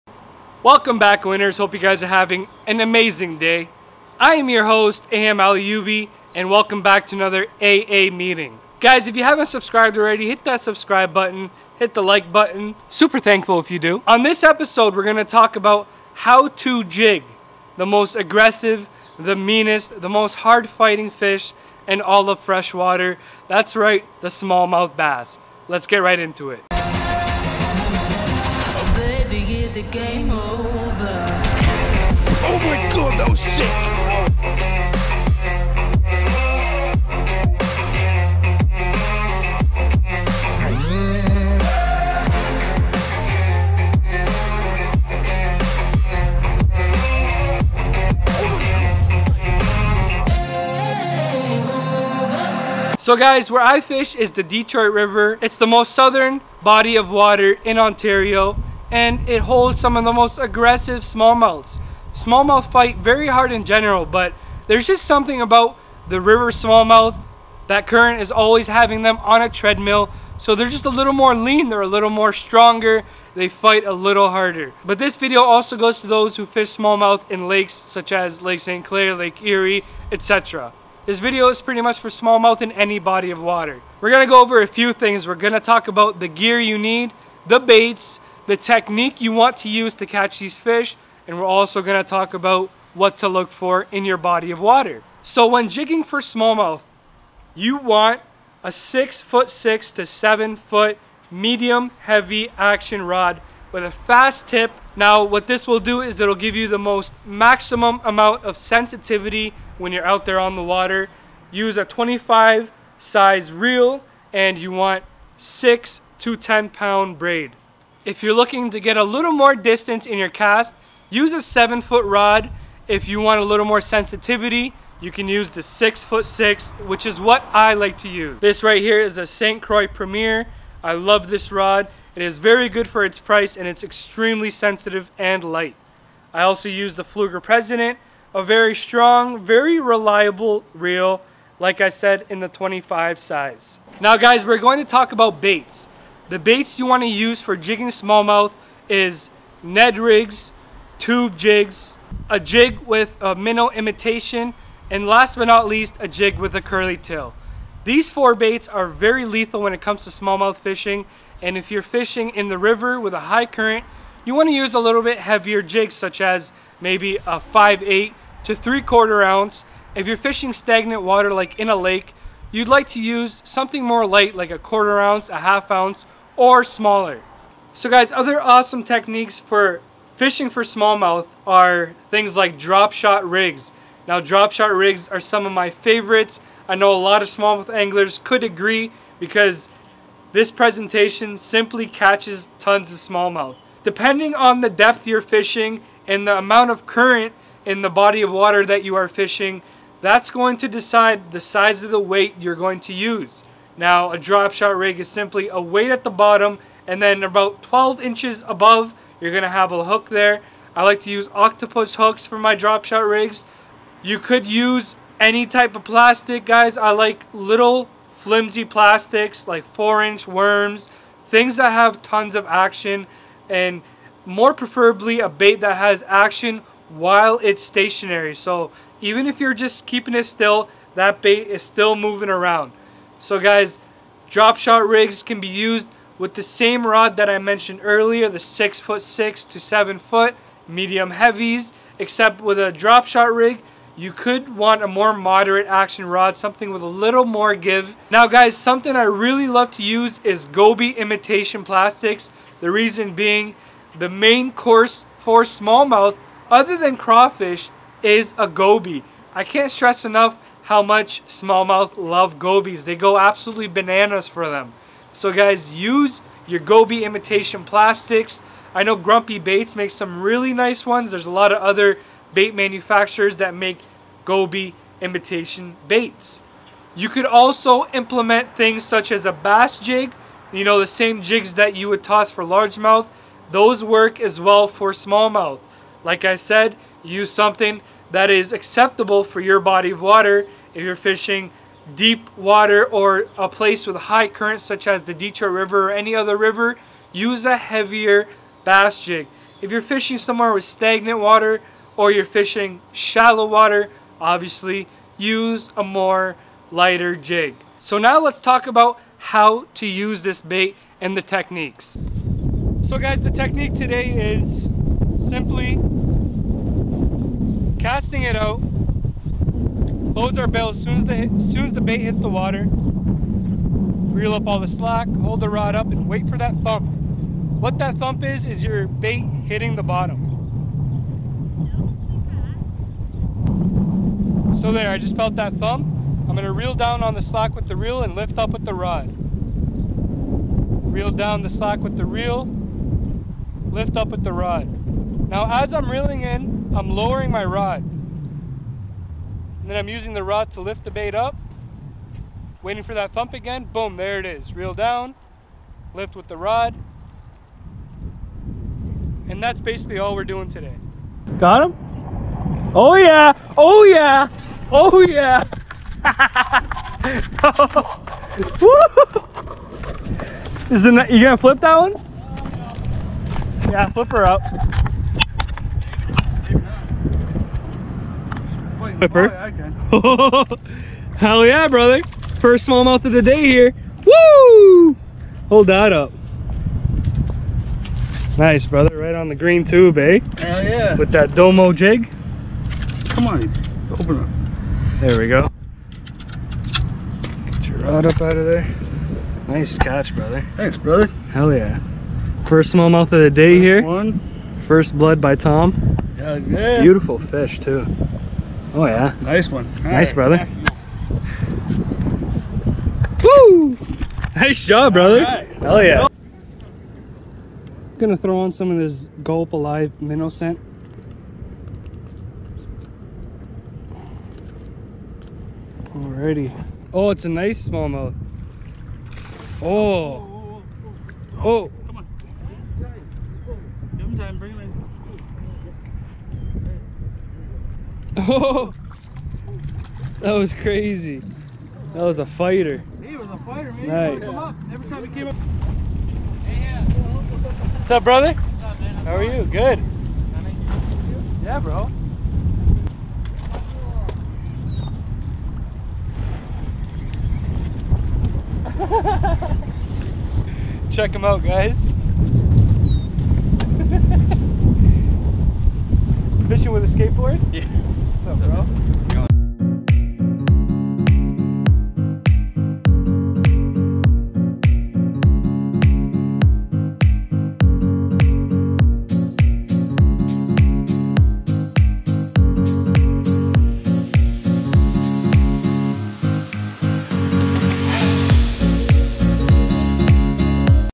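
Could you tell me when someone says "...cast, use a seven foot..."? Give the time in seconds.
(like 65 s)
120 s.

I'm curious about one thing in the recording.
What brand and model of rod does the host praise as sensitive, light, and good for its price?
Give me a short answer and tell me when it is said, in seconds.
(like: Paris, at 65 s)
St. Croix Premier, at 129 s.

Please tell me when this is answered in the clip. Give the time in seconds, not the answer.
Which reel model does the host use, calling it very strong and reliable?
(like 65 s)
137 s.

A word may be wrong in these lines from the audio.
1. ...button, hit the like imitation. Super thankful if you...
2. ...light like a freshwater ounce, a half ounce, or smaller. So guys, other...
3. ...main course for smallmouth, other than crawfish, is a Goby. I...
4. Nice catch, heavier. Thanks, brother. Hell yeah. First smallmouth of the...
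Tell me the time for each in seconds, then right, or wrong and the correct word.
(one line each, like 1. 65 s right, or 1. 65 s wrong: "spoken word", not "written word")
1. 11 s wrong: "button", not "imitation"
2. 174 s wrong: "quarter", not "freshwater"
3. 254 s right
4. 399 s wrong: "brother", not "heavier".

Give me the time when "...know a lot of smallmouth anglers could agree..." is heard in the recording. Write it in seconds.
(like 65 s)
186 s.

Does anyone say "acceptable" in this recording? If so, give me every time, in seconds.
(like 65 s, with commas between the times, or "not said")
288 s.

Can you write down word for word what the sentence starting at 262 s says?
They go absolutely bananas for them.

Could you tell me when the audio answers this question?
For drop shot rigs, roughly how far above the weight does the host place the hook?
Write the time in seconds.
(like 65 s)
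207 s.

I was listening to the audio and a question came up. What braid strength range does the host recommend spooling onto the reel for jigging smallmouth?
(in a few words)
6 to 10 pound.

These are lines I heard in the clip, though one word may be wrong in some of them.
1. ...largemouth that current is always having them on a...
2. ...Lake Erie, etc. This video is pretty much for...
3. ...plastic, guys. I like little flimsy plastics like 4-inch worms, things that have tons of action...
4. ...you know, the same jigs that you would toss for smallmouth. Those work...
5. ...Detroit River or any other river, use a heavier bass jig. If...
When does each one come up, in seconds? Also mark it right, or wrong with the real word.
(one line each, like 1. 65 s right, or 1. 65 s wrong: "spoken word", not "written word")
1. 66 s wrong: "smallmouth", not "largemouth"
2. 79 s right
3. 215 s right
4. 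280 s wrong: "largemouth", not "smallmouth"
5. 295 s right.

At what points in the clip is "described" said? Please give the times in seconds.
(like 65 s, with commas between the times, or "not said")
not said.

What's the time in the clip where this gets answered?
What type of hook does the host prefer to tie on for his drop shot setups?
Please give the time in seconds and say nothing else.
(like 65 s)
211 s.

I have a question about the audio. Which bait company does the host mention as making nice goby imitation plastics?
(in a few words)
Grumpy Baits.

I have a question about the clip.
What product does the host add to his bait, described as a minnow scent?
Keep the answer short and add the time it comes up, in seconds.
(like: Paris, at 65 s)
Gulp Alive, at 419 s.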